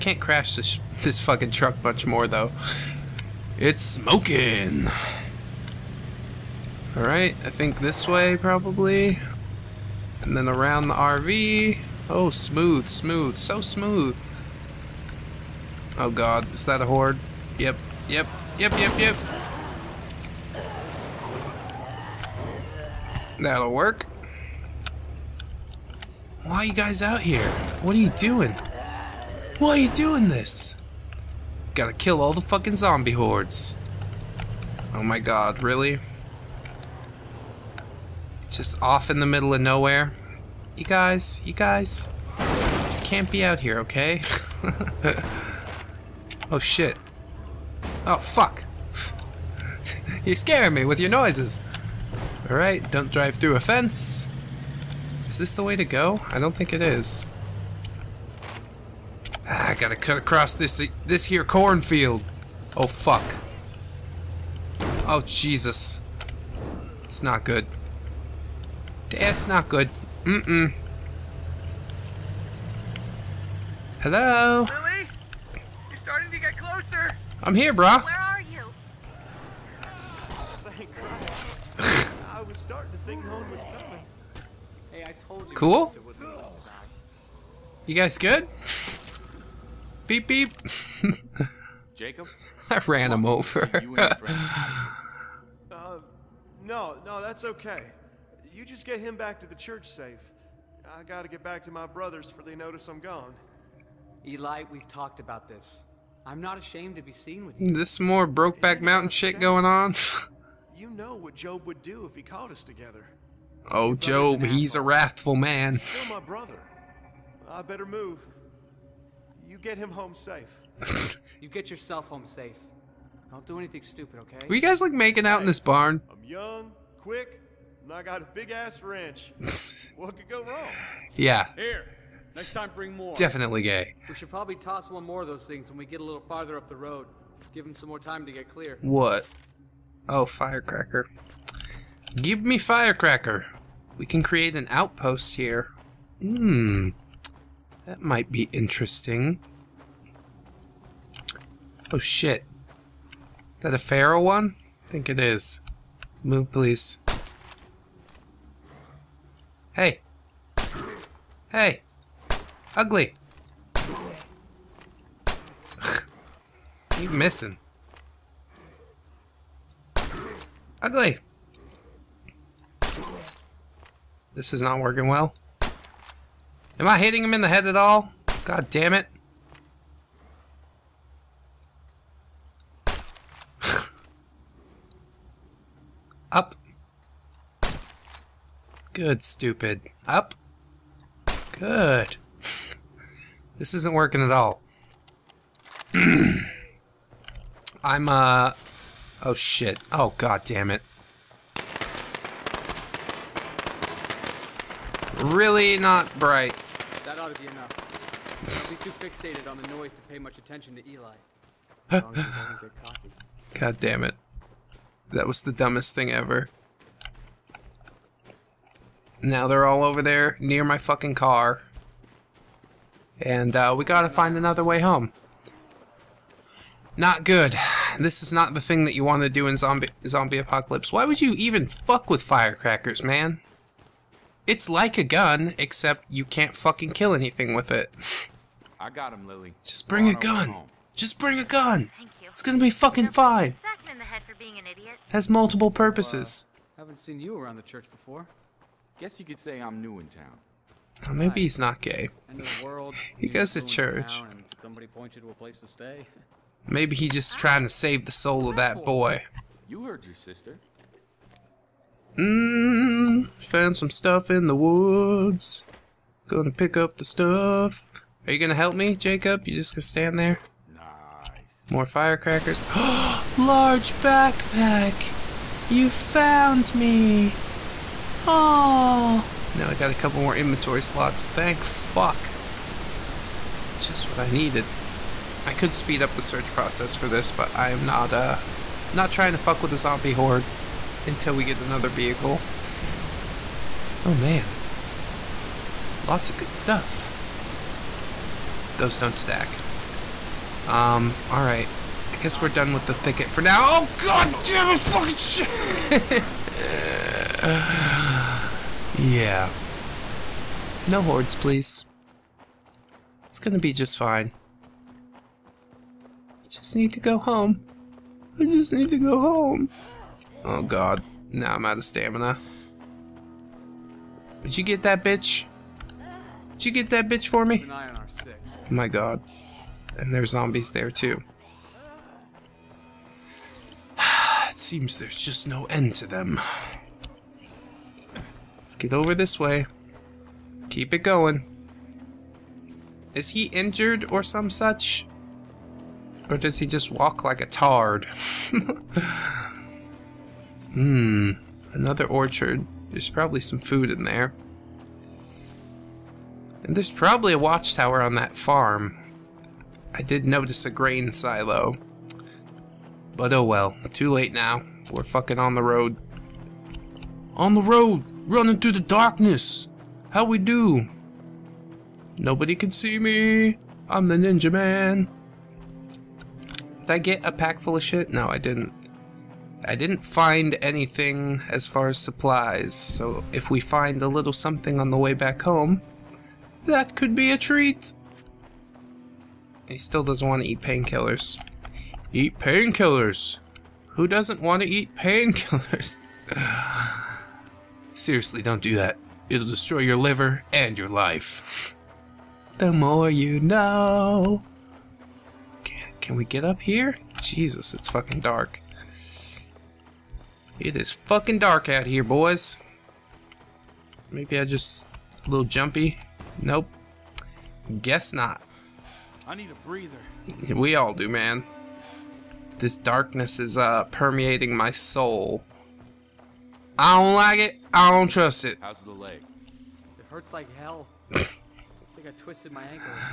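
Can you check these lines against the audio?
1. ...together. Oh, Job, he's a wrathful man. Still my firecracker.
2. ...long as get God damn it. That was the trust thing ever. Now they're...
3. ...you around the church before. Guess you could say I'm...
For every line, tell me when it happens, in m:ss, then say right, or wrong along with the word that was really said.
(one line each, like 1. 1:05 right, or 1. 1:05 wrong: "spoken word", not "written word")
1. 1:52 wrong: "brother", not "firecracker"
2. 3:32 wrong: "dumbest", not "trust"
3. 4:07 right.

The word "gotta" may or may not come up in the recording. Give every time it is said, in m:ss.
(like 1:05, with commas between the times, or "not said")
0:31, 0:59, 1:41, 3:43.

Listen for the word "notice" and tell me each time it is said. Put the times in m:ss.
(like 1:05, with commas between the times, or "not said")
1:42, 6:00.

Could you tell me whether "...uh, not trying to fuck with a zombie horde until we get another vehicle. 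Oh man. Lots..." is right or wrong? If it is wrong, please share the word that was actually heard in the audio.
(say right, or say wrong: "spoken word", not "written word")
right.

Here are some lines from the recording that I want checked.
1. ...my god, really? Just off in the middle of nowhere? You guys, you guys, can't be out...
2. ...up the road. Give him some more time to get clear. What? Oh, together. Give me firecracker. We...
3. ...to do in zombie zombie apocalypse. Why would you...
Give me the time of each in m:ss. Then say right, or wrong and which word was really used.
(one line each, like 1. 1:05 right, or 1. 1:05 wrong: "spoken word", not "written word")
1. 0:35 right
2. 2:16 wrong: "firecracker", not "together"
3. 3:49 right.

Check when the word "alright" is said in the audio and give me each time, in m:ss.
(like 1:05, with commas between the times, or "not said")
0:06, 0:52, 5:01.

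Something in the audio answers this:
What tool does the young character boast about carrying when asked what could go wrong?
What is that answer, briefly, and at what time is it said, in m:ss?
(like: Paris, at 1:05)
wrench, at 2:08.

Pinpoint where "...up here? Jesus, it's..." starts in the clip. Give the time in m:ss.
6:46.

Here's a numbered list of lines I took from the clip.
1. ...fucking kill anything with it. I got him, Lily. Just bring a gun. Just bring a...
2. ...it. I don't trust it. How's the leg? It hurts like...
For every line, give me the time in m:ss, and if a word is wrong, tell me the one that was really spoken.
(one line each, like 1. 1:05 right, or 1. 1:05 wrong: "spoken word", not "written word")
1. 3:56 right
2. 7:07 right.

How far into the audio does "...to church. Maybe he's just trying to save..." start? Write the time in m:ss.
4:13.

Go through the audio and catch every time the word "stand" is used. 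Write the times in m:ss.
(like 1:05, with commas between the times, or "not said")
4:29.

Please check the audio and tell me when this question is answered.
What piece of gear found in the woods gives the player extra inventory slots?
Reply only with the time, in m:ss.
4:32.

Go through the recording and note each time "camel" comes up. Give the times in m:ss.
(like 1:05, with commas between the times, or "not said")
not said.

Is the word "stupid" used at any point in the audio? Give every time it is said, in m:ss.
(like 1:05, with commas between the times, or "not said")
2:03, 3:09.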